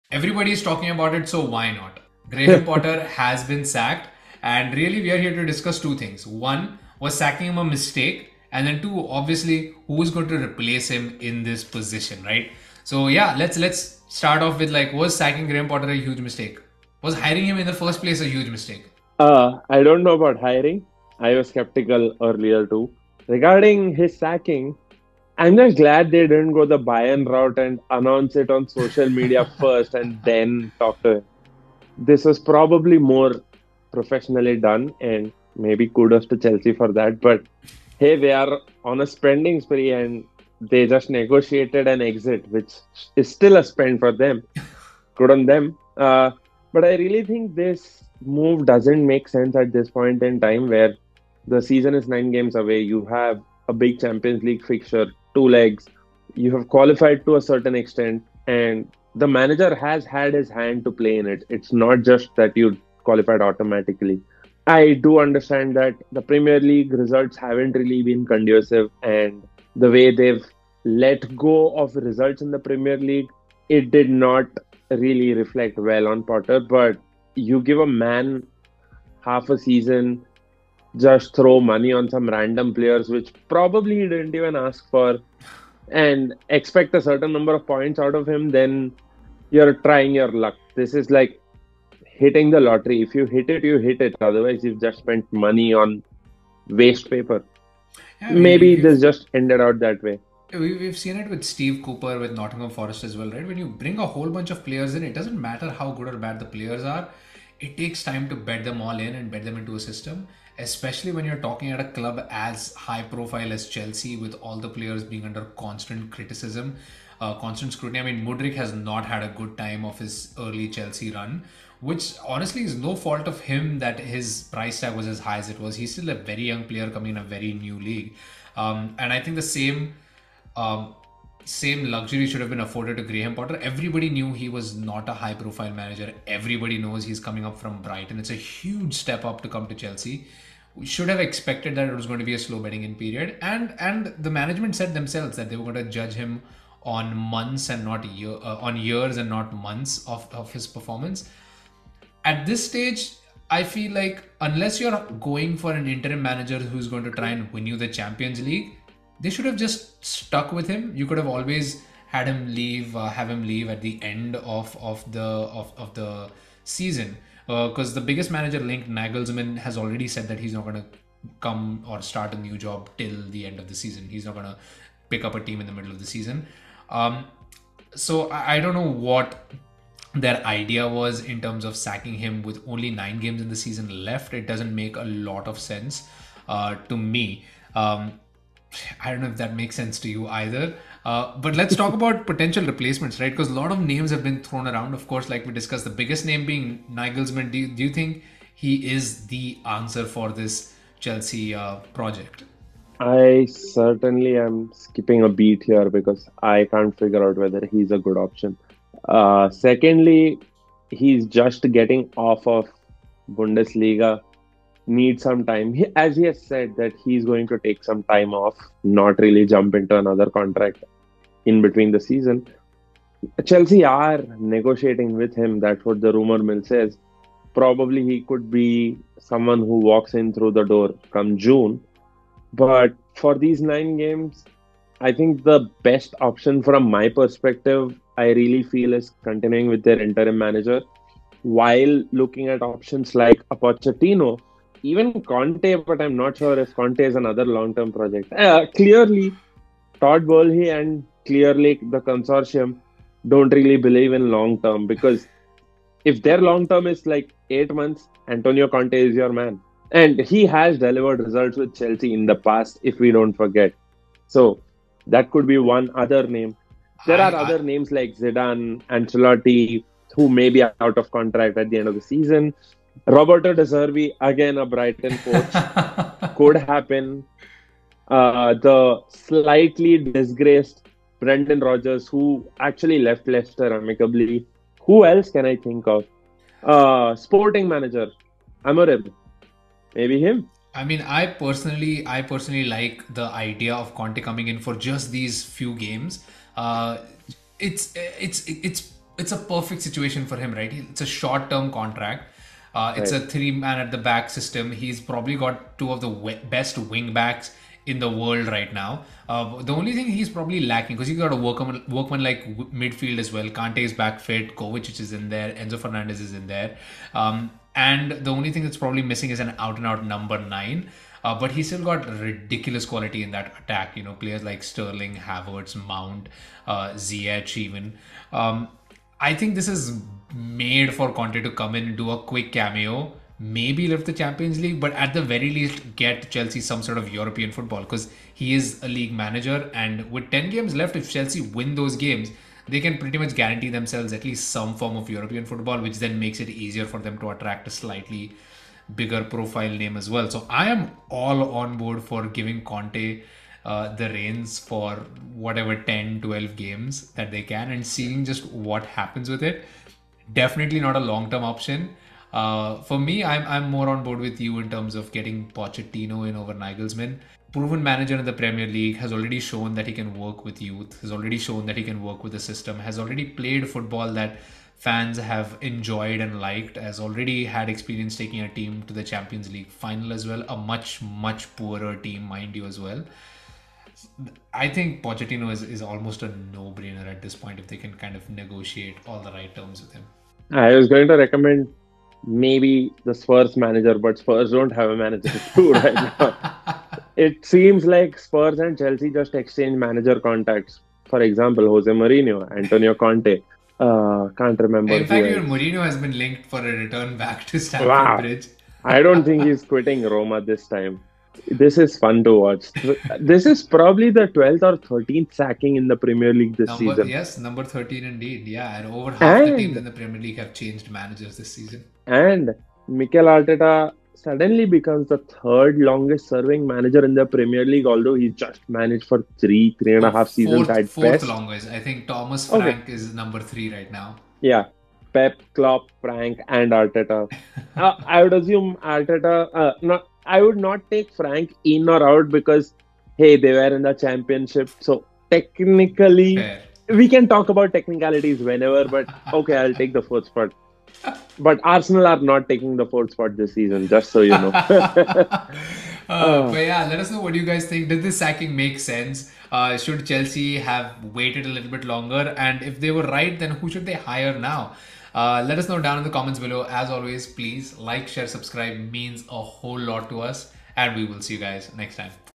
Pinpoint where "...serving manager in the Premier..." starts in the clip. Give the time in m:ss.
7:06.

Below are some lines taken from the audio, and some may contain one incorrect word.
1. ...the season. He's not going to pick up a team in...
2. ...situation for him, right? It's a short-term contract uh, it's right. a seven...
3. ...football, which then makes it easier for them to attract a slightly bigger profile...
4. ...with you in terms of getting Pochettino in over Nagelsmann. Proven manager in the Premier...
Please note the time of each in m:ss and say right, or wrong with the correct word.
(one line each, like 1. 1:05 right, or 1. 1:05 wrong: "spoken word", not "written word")
1. 2:53 right
2. 4:59 wrong: "three", not "seven"
3. 5:45 right
4. 6:04 right.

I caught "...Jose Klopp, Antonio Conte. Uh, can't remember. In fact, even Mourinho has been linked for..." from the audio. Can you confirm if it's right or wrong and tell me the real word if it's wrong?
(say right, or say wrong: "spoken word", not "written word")
wrong: "Mourinho", not "Klopp".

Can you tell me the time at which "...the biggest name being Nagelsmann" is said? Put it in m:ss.
3:15.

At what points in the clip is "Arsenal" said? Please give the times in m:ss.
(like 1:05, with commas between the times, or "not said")
7:31.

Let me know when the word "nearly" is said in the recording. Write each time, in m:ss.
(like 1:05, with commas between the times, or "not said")
not said.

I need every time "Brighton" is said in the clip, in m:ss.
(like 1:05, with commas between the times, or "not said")
2:17, 4:34.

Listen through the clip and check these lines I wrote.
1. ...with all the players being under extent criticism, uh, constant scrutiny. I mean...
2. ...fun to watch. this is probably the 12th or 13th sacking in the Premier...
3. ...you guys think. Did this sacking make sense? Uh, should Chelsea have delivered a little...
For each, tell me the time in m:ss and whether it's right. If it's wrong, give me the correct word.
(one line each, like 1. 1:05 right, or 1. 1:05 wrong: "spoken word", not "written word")
1. 1:54 wrong: "constant", not "extent"
2. 6:51 right
3. 7:37 wrong: "waited", not "delivered".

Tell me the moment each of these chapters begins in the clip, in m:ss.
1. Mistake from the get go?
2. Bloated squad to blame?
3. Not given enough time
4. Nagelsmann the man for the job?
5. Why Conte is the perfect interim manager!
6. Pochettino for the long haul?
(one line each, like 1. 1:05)
1. 0:14
2. 1:40
3. 2:11
4. 3:22
5. 4:30
6. 6:02.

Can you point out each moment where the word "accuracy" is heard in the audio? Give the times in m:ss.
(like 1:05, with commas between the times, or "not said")
not said.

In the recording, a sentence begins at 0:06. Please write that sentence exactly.
One, was sacking him a mistake?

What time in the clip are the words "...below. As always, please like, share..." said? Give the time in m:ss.
7:46.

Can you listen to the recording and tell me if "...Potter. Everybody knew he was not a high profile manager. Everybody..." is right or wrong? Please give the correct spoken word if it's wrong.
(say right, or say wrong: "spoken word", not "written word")
right.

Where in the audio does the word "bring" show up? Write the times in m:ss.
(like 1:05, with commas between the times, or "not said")
1:43.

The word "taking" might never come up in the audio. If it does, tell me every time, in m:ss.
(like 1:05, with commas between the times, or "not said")
6:18, 7:32.